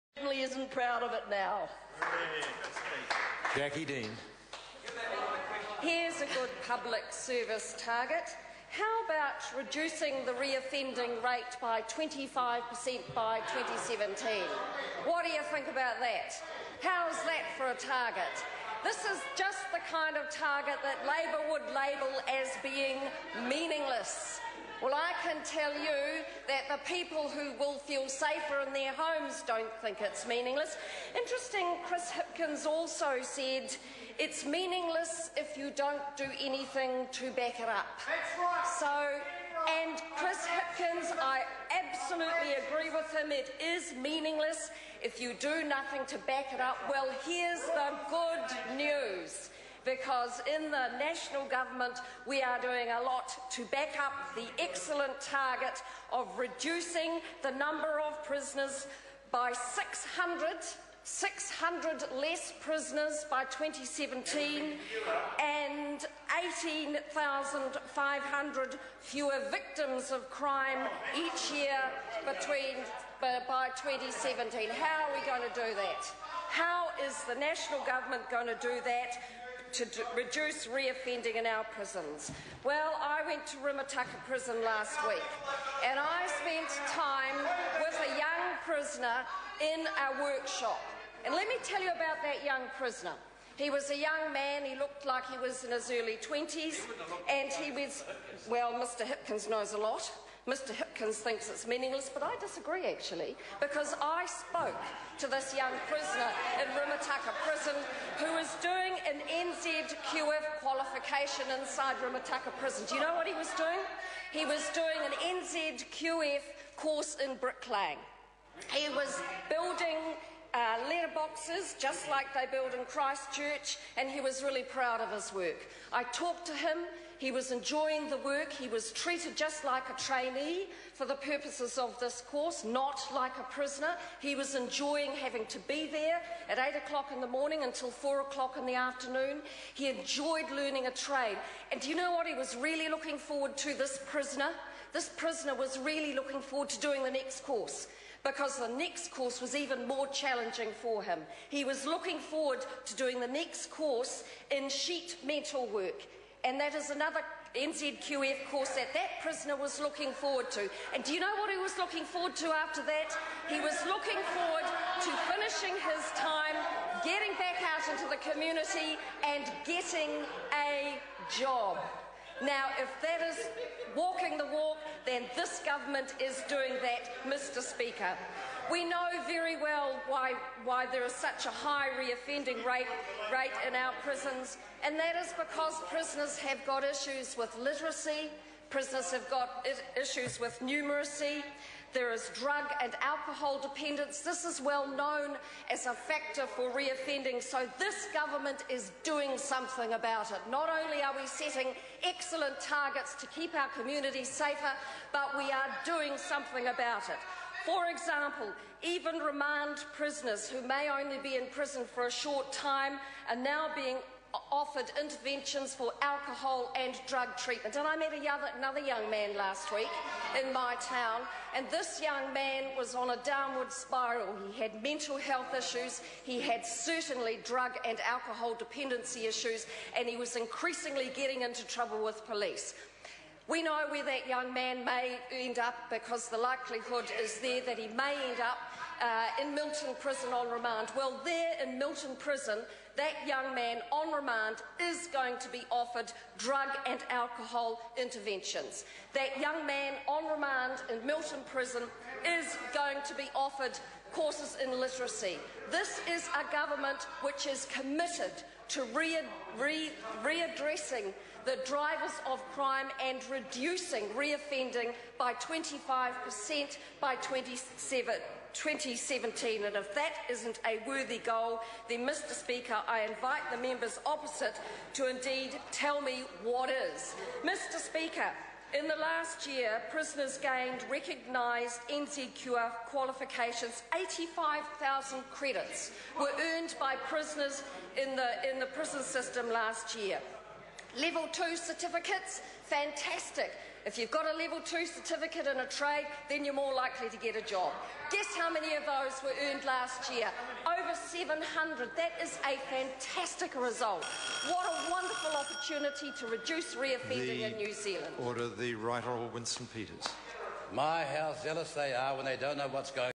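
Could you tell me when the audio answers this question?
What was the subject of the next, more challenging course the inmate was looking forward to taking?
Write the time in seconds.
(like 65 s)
154 s.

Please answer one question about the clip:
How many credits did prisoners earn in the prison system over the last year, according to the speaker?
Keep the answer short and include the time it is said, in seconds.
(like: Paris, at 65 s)
85,000, at 283 s.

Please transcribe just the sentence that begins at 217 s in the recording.
And I met another young man last week in my town, and this young man was on a downward spiral.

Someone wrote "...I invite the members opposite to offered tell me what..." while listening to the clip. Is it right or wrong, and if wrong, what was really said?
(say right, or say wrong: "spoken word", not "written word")
wrong: "indeed", not "offered".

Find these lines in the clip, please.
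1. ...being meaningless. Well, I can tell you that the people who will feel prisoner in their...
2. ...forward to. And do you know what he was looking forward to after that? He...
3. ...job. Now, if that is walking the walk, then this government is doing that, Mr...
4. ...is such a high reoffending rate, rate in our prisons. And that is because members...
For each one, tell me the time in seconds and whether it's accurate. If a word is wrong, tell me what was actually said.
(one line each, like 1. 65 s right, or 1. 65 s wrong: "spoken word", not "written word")
1. 22 s wrong: "safer", not "prisoner"
2. 160 s right
3. 171 s right
4. 181 s wrong: "prisoners", not "members".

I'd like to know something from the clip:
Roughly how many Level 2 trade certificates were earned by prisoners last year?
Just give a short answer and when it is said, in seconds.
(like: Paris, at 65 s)
Over 700, at 300 s.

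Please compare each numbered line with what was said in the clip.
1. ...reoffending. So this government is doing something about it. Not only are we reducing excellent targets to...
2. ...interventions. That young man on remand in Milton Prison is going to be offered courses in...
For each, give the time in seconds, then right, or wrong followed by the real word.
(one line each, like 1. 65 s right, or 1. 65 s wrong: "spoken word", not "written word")
1. 196 s wrong: "setting", not "reducing"
2. 247 s right.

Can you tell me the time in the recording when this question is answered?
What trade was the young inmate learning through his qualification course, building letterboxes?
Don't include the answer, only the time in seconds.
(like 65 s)
117 s.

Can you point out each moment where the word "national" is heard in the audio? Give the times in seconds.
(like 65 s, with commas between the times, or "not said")
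50 s, 77 s.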